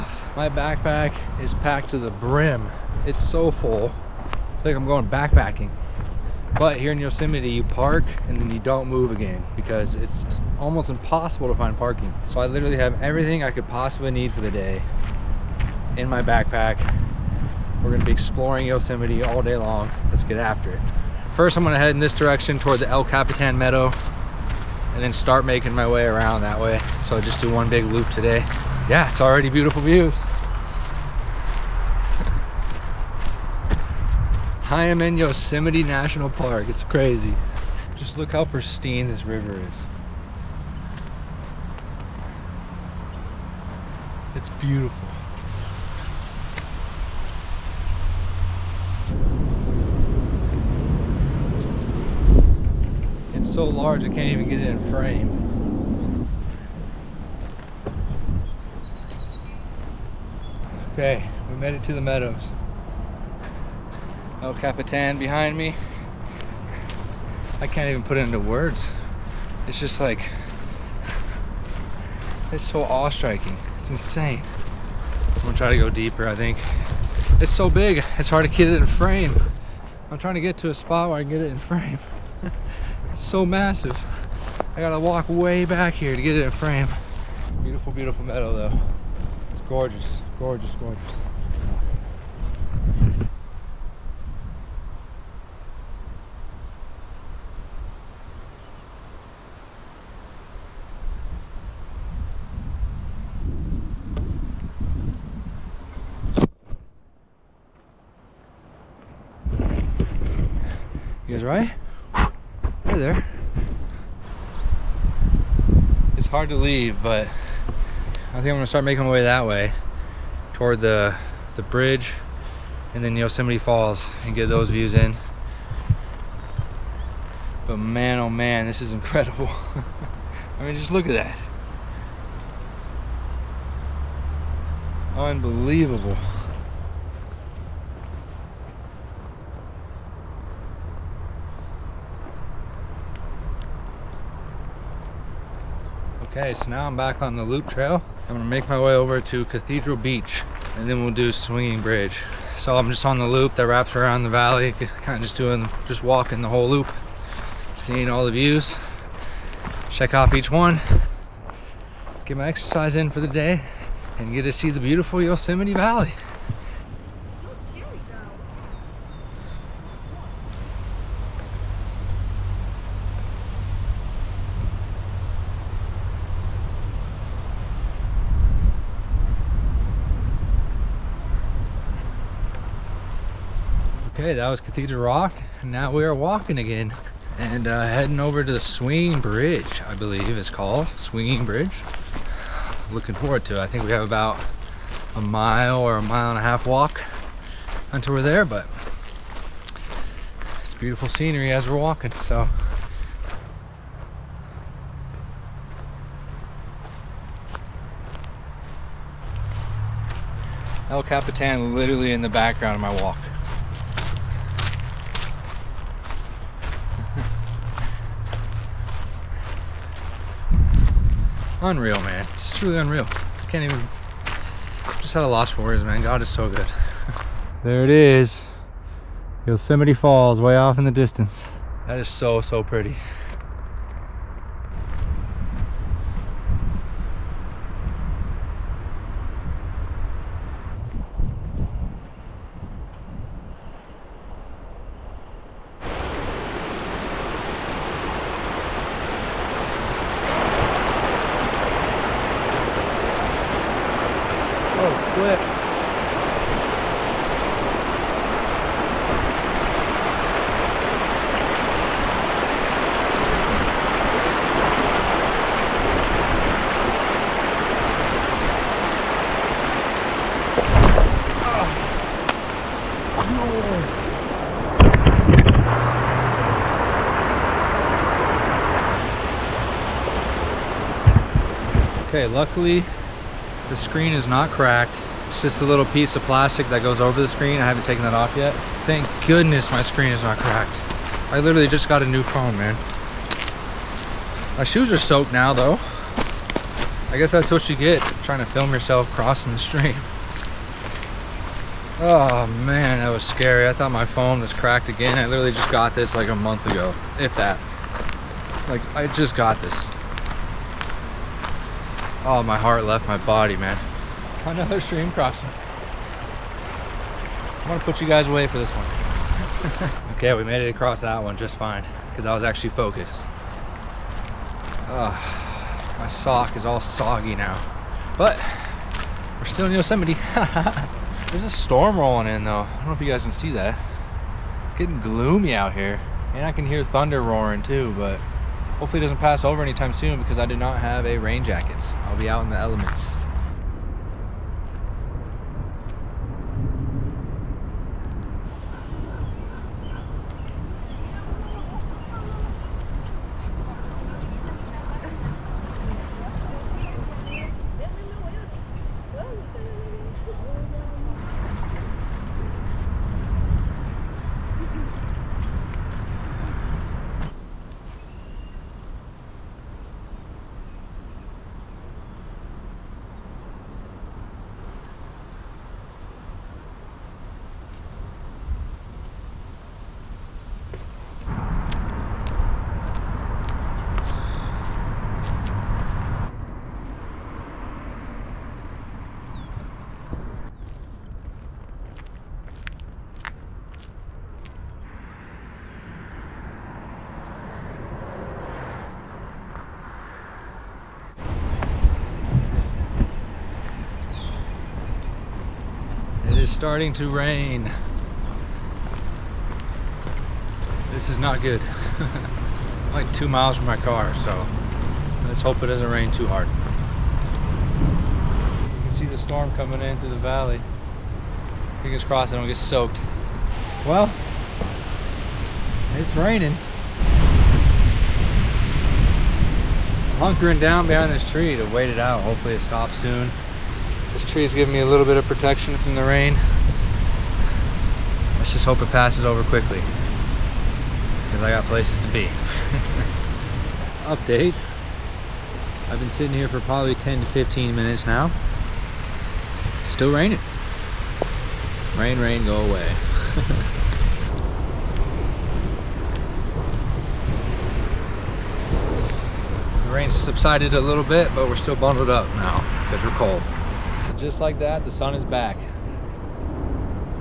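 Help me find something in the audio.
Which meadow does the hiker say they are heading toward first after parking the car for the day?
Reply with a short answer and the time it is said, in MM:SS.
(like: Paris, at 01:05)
El Capitan Meadow, at 00:22.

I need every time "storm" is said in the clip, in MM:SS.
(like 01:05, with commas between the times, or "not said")
05:31, 06:59.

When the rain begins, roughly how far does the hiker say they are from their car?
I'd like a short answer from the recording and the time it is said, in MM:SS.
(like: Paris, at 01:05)
2 miles, at 06:53.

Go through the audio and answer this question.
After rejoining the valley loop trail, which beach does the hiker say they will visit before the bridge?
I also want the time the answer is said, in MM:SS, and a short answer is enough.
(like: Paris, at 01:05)
Cathedral Beach, at 02:29.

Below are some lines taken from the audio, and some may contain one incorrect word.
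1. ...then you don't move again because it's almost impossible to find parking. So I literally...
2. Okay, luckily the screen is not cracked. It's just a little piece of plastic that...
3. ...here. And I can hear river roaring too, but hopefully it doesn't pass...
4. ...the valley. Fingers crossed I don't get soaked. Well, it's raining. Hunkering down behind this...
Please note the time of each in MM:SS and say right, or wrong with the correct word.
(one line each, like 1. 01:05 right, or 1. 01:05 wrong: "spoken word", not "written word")
1. 00:08 right
2. 04:42 right
3. 05:35 wrong: "thunder", not "river"
4. 07:00 right.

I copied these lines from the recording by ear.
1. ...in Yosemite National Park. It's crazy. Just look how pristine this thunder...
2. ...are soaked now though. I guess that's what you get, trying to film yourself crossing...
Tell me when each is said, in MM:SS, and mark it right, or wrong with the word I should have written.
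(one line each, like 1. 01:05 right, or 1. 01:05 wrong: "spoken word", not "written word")
1. 00:35 wrong: "river", not "thunder"
2. 04:54 right.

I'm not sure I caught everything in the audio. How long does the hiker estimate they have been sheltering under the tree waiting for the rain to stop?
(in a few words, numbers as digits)
10 to 15 minutes.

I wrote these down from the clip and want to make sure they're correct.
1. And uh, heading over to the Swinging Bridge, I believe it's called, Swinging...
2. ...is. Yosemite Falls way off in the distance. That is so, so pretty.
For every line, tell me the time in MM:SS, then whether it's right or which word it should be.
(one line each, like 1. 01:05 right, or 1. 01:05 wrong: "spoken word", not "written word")
1. 03:07 right
2. 03:47 right.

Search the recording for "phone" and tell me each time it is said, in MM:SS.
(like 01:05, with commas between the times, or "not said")
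04:52, 05:04.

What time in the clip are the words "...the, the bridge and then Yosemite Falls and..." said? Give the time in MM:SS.
02:00.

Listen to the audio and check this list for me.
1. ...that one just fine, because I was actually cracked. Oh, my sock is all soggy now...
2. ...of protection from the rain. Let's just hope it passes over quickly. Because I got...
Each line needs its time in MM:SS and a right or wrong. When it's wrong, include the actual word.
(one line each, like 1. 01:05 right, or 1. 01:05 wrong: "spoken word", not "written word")
1. 05:21 wrong: "focused", not "cracked"
2. 07:15 right.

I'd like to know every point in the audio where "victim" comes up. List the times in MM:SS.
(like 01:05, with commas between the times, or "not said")
not said.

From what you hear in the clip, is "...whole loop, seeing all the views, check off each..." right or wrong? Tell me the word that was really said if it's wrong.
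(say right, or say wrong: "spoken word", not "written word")
right.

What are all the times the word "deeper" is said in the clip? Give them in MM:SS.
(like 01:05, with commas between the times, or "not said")
01:15.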